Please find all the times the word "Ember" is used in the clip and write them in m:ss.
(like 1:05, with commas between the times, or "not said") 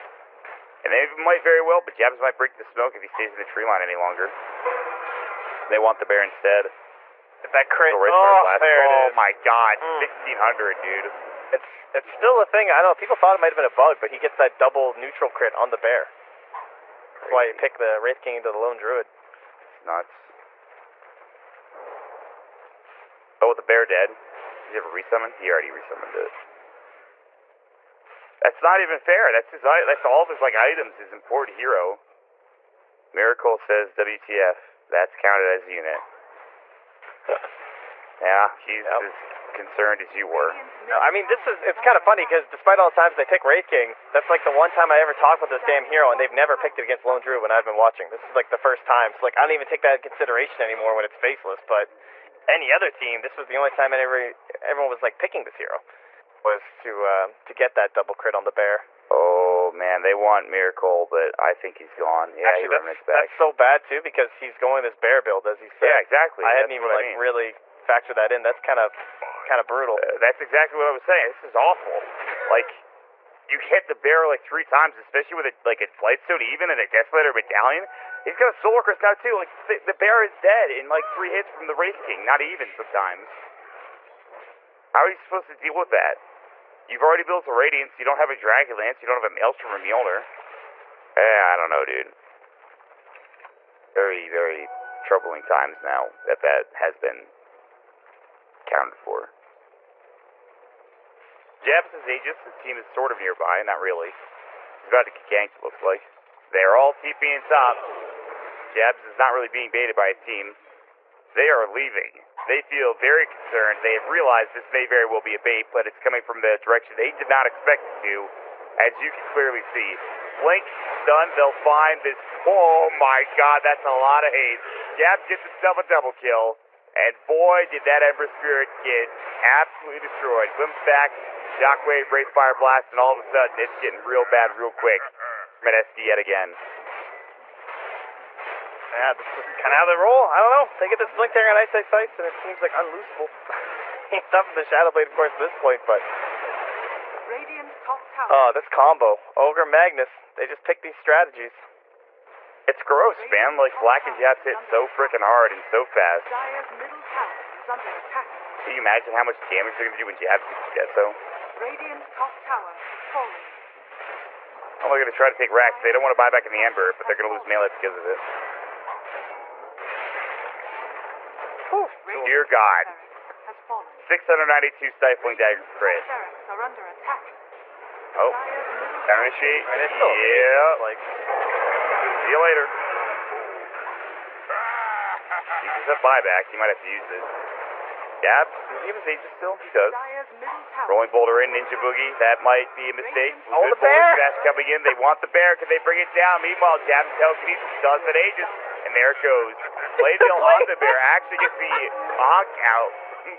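2:08, 2:46.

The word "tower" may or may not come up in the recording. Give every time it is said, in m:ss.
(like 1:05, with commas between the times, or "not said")
2:28, 2:42.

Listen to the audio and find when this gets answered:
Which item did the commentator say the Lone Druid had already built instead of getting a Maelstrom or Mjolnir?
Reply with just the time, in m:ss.
1:27.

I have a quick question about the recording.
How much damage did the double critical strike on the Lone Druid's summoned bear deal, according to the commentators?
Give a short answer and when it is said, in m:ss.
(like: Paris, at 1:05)
1600, at 0:09.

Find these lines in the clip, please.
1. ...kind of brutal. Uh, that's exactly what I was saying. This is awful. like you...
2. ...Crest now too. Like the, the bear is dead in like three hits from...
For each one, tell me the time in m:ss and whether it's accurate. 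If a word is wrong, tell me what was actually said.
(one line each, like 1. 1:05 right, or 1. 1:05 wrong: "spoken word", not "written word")
1. 1:09 right
2. 1:18 right.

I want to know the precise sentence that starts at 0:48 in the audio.
This is like the first time.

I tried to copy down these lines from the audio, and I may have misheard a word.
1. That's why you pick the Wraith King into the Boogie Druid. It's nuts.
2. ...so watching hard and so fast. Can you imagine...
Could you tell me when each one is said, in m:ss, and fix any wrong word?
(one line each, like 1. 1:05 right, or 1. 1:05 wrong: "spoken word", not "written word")
1. 0:17 wrong: "Lone", not "Boogie"
2. 2:34 wrong: "freaking", not "watching".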